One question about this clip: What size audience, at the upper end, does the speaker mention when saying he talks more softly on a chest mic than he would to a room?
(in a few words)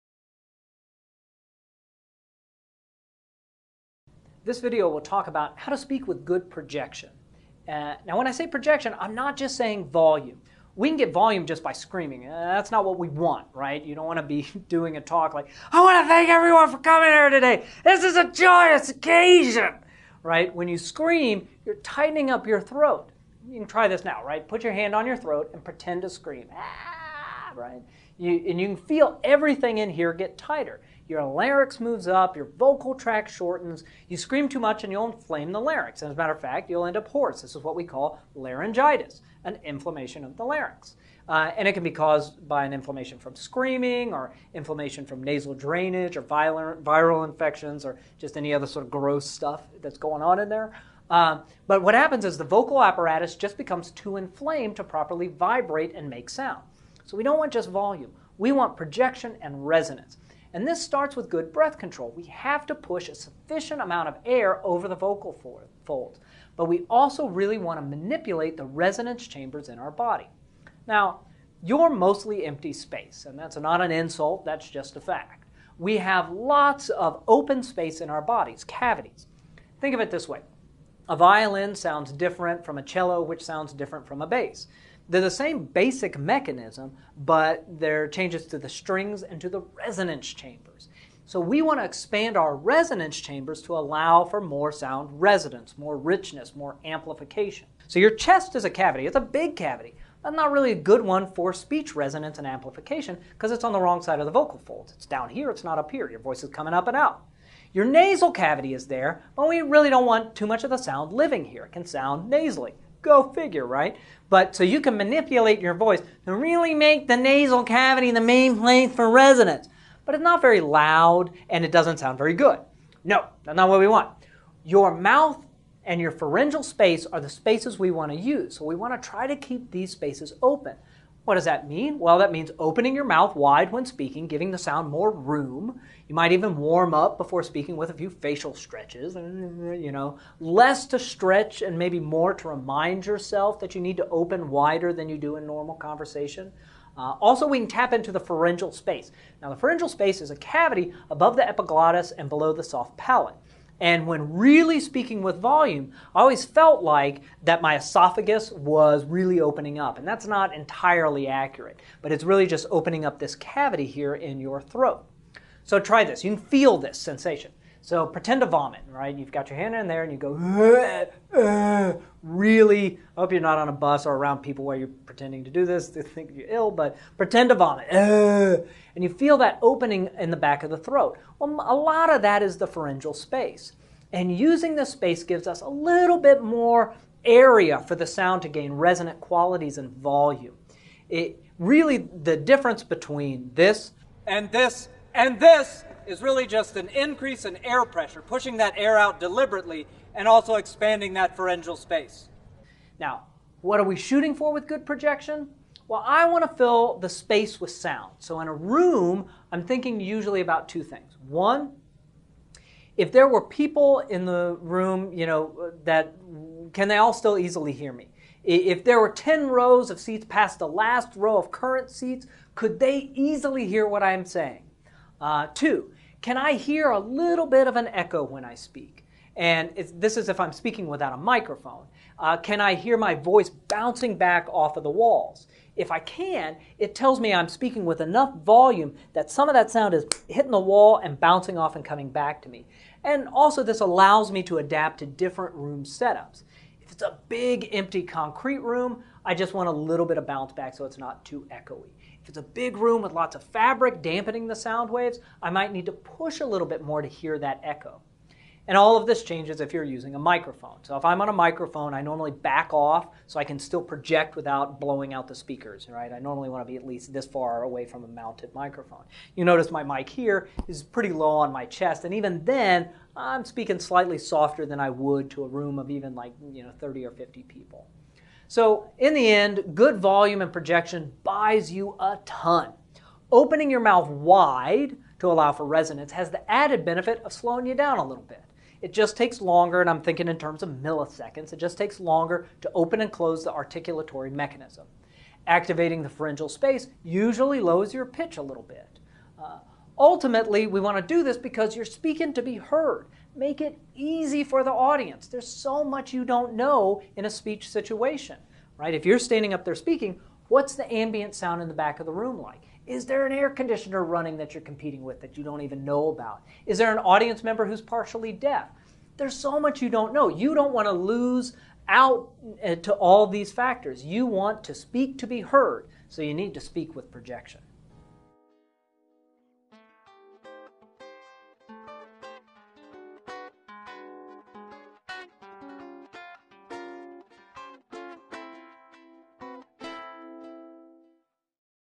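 50 people.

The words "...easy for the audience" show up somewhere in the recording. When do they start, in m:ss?
5:03.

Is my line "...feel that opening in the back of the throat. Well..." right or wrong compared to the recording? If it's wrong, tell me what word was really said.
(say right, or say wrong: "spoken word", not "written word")
right.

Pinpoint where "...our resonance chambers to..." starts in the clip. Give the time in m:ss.
1:32.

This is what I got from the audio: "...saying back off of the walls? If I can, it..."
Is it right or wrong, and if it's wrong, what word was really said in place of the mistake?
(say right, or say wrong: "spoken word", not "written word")
wrong: "bouncing", not "saying".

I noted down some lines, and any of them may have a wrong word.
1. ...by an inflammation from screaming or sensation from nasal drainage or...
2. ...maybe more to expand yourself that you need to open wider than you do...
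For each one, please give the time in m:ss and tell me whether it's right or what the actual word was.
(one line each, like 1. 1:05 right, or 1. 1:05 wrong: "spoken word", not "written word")
1. 0:42 wrong: "inflammation", not "sensation"
2. 2:21 wrong: "remind", not "expand".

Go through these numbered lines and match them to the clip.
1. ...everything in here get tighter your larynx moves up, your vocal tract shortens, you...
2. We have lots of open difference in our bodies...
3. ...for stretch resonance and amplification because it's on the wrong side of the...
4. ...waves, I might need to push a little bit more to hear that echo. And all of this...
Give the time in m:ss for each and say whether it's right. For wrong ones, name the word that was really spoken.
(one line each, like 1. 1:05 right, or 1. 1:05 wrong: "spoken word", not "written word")
1. 0:29 right
2. 1:15 wrong: "space", not "difference"
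3. 1:41 wrong: "speech", not "stretch"
4. 4:14 right.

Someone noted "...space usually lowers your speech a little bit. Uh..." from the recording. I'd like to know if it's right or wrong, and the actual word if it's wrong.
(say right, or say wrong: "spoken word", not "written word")
wrong: "pitch", not "speech".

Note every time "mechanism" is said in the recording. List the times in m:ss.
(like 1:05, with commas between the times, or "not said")
1:26, 4:54.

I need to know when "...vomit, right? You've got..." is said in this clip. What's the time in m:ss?
2:48.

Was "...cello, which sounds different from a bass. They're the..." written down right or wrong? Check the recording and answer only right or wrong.
right.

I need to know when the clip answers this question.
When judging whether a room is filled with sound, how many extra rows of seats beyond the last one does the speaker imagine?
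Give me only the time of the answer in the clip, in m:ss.
3:39.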